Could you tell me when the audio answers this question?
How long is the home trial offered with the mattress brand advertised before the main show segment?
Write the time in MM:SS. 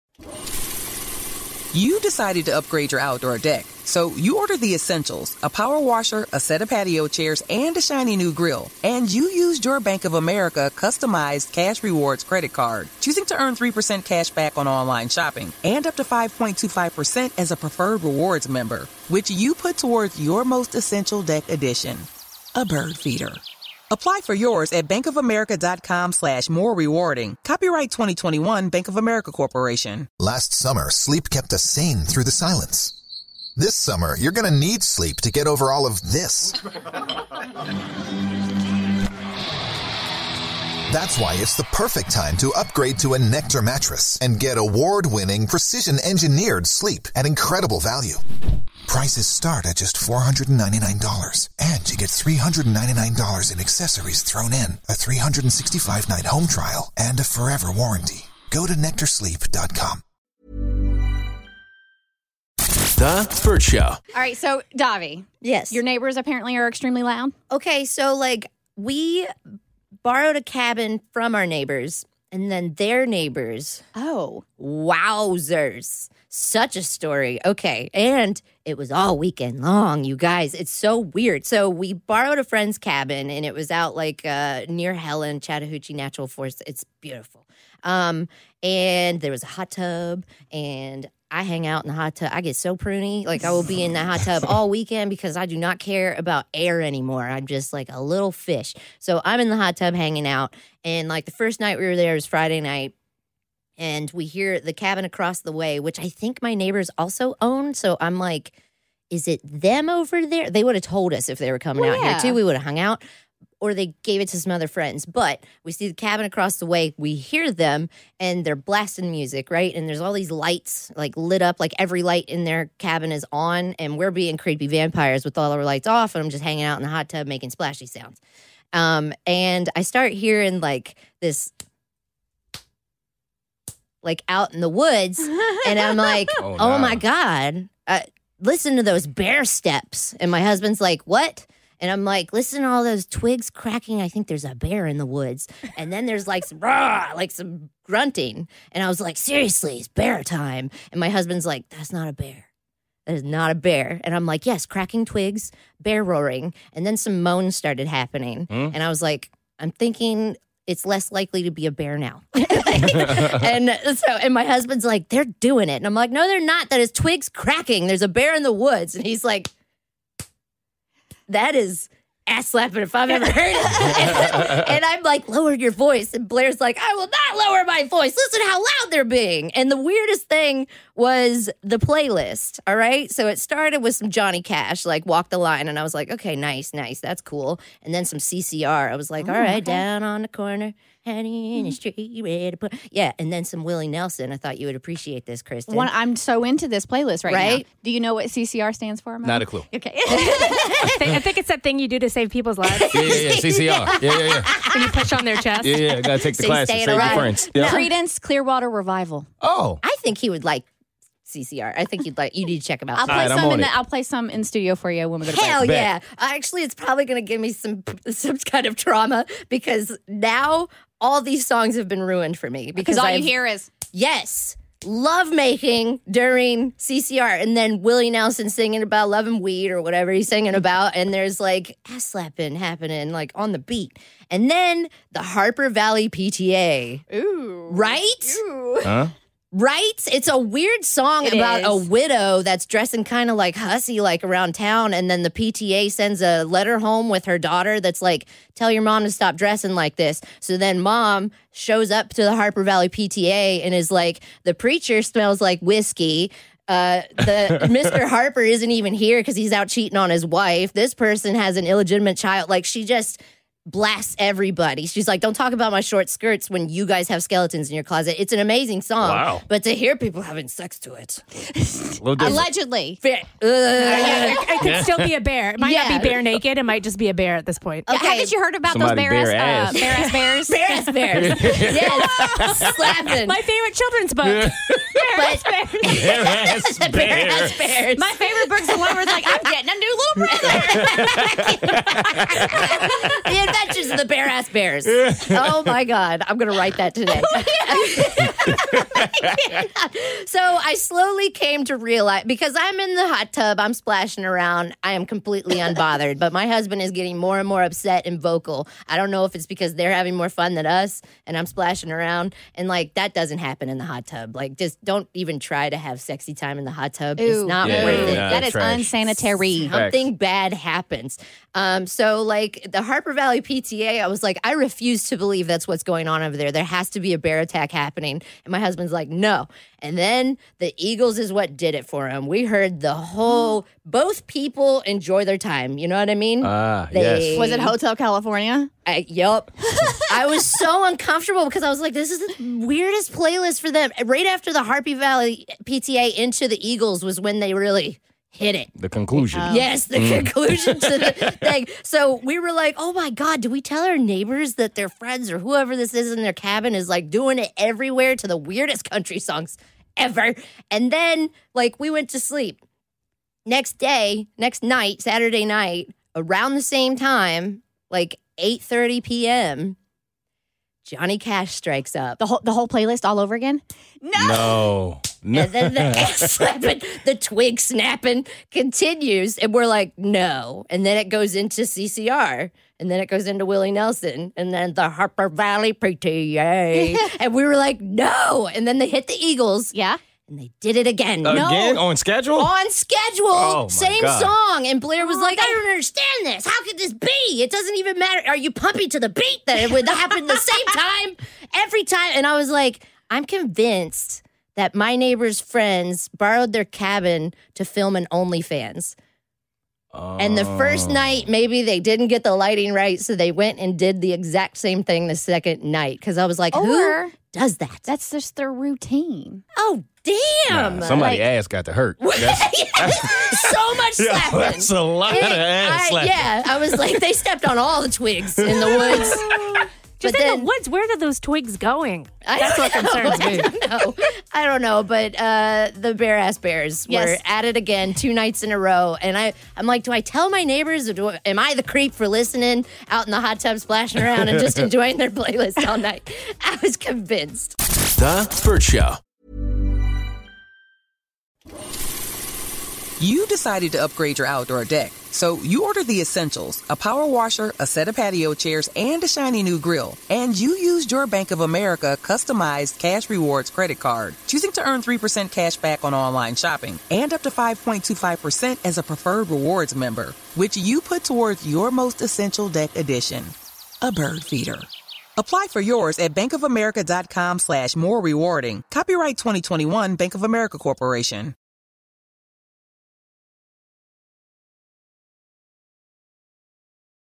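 00:54.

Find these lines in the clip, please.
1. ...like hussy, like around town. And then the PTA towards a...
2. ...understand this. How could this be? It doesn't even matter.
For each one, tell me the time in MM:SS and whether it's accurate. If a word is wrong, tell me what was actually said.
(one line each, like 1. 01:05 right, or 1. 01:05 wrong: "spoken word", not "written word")
1. 04:03 wrong: "sends", not "towards"
2. 06:35 right.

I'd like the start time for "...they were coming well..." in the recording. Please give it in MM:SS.
01:51.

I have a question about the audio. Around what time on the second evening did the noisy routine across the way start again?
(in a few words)
8:30 p.m.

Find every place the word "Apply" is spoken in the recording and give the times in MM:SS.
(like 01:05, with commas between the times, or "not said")
00:23, 07:55.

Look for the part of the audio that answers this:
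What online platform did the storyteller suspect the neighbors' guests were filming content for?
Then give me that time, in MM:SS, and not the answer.
06:48.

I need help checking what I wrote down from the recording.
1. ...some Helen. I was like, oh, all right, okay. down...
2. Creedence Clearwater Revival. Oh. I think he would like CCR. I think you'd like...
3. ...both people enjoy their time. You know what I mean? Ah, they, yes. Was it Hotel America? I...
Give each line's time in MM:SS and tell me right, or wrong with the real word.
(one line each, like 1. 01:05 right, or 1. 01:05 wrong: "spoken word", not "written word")
1. 03:08 wrong: "CCR", not "Helen"
2. 03:27 right
3. 05:33 wrong: "California", not "America".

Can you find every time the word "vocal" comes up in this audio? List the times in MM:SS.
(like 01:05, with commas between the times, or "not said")
05:08.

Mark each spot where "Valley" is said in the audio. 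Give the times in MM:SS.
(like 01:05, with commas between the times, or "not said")
03:55, 04:12, 05:23, 05:44, 06:25.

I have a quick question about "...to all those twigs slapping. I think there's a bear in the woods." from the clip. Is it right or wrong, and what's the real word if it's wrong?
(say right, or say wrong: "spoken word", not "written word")
wrong: "cracking", not "slapping".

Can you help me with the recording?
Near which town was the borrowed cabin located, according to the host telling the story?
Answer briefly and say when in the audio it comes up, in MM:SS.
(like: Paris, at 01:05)
Helen, at 01:24.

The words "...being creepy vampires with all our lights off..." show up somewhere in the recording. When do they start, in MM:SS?
02:04.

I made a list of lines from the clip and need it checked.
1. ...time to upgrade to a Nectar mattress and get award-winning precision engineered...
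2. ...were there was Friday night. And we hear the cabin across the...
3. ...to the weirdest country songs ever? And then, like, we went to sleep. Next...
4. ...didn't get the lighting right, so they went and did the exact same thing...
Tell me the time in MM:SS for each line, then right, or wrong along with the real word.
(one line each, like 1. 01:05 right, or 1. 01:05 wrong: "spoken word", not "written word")
1. 00:42 right
2. 01:41 right
3. 05:58 right
4. 06:51 right.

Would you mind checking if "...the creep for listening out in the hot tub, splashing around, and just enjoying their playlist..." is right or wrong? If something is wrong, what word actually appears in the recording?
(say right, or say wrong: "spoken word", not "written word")
right.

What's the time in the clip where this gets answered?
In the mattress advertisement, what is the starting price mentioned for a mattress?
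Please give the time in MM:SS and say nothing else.
00:49.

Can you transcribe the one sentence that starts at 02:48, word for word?
And he's like, that is ass slapping if I've ever heard it.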